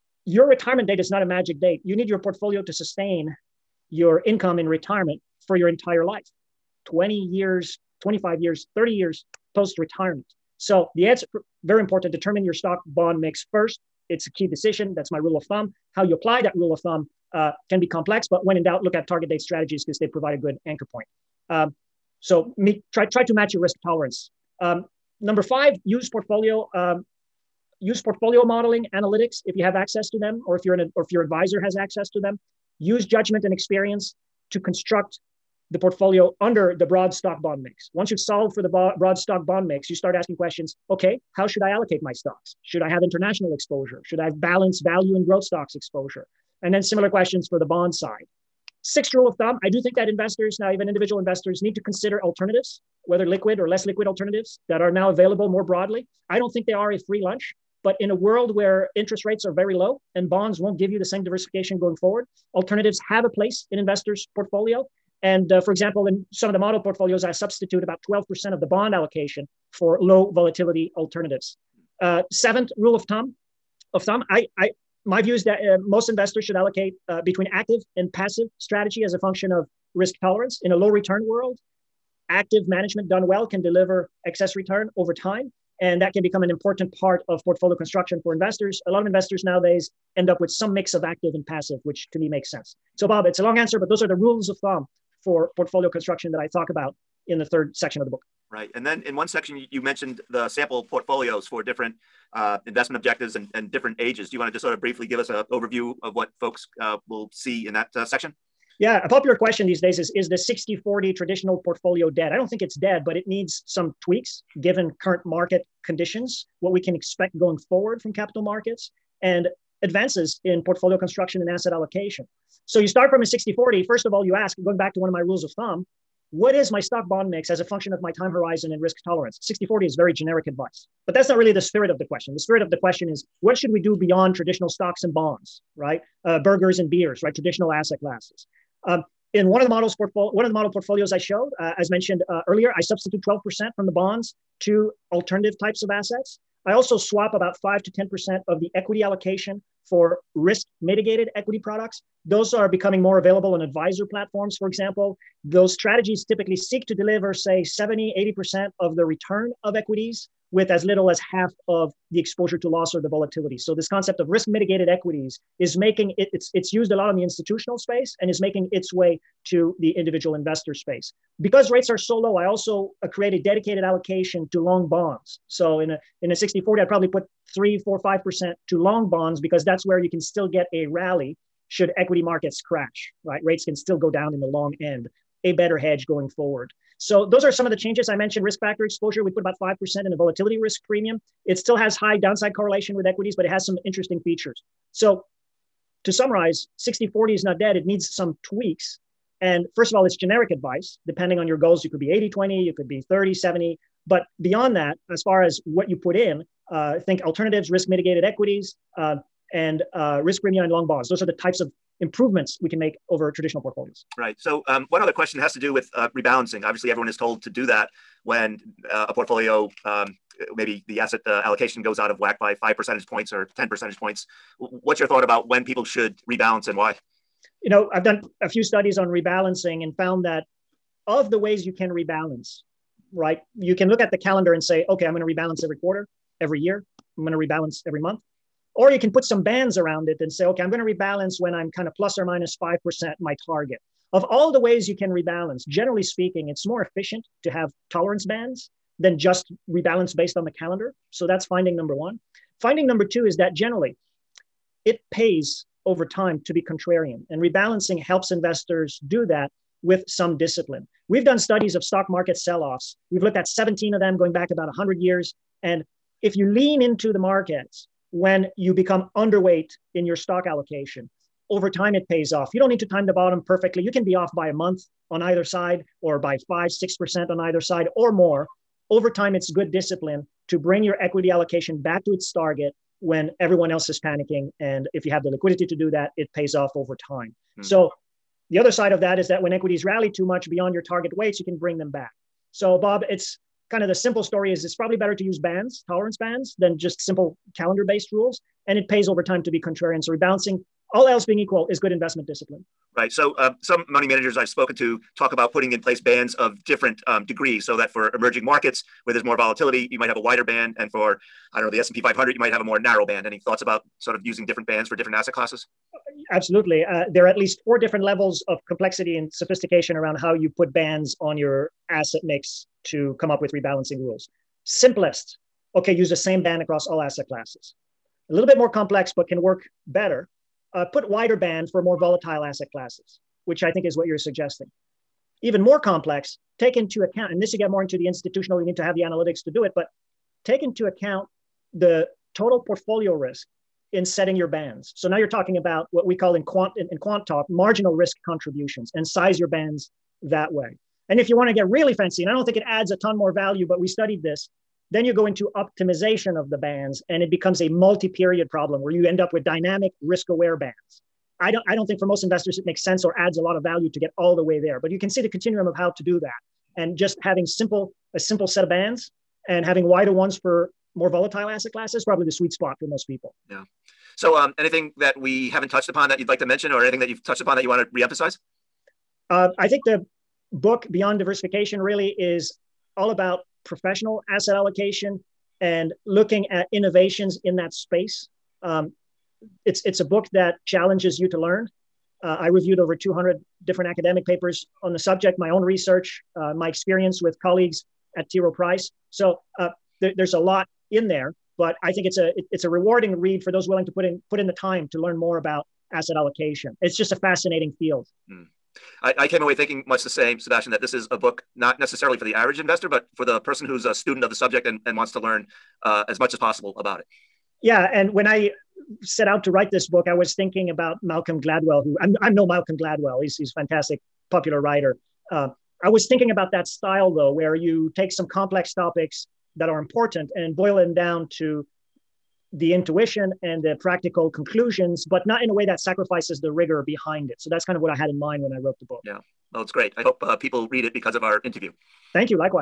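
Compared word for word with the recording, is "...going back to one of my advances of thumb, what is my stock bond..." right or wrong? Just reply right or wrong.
wrong.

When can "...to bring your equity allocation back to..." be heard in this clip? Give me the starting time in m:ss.
4:40.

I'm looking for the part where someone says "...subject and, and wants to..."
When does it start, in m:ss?
6:54.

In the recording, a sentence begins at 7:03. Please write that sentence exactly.
He's, he's a fantastic, popular writer.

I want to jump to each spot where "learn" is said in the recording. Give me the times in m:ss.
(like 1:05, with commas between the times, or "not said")
6:31, 6:44, 6:55.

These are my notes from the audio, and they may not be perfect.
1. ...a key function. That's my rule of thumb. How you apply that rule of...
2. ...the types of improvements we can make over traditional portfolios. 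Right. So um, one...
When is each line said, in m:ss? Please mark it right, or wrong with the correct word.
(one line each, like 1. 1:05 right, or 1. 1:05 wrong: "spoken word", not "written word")
1. 0:14 wrong: "decision", not "function"
2. 3:31 right.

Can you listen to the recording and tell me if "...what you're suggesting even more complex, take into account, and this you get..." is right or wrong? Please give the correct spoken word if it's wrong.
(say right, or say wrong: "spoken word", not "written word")
right.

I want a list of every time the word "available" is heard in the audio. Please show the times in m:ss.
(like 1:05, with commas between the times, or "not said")
0:55, 2:33.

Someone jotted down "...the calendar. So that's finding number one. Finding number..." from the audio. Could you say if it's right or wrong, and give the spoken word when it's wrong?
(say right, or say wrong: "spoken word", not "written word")
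right.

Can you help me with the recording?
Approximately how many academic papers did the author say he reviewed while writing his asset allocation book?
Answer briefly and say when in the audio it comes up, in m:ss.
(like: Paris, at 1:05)
Over 200, at 6:32.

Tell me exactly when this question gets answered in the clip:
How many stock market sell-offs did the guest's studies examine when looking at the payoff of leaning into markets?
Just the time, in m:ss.
4:23.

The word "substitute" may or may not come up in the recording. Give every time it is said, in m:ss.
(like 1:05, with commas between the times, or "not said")
1:07, 2:22.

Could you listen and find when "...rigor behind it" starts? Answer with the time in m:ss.
7:16.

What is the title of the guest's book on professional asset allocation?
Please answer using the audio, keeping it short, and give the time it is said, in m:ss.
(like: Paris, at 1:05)
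Beyond Diversification, at 6:20.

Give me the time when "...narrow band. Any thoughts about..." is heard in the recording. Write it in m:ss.
5:12.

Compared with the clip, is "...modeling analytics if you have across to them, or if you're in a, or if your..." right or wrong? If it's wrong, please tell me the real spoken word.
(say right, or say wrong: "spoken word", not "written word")
wrong: "access", not "across".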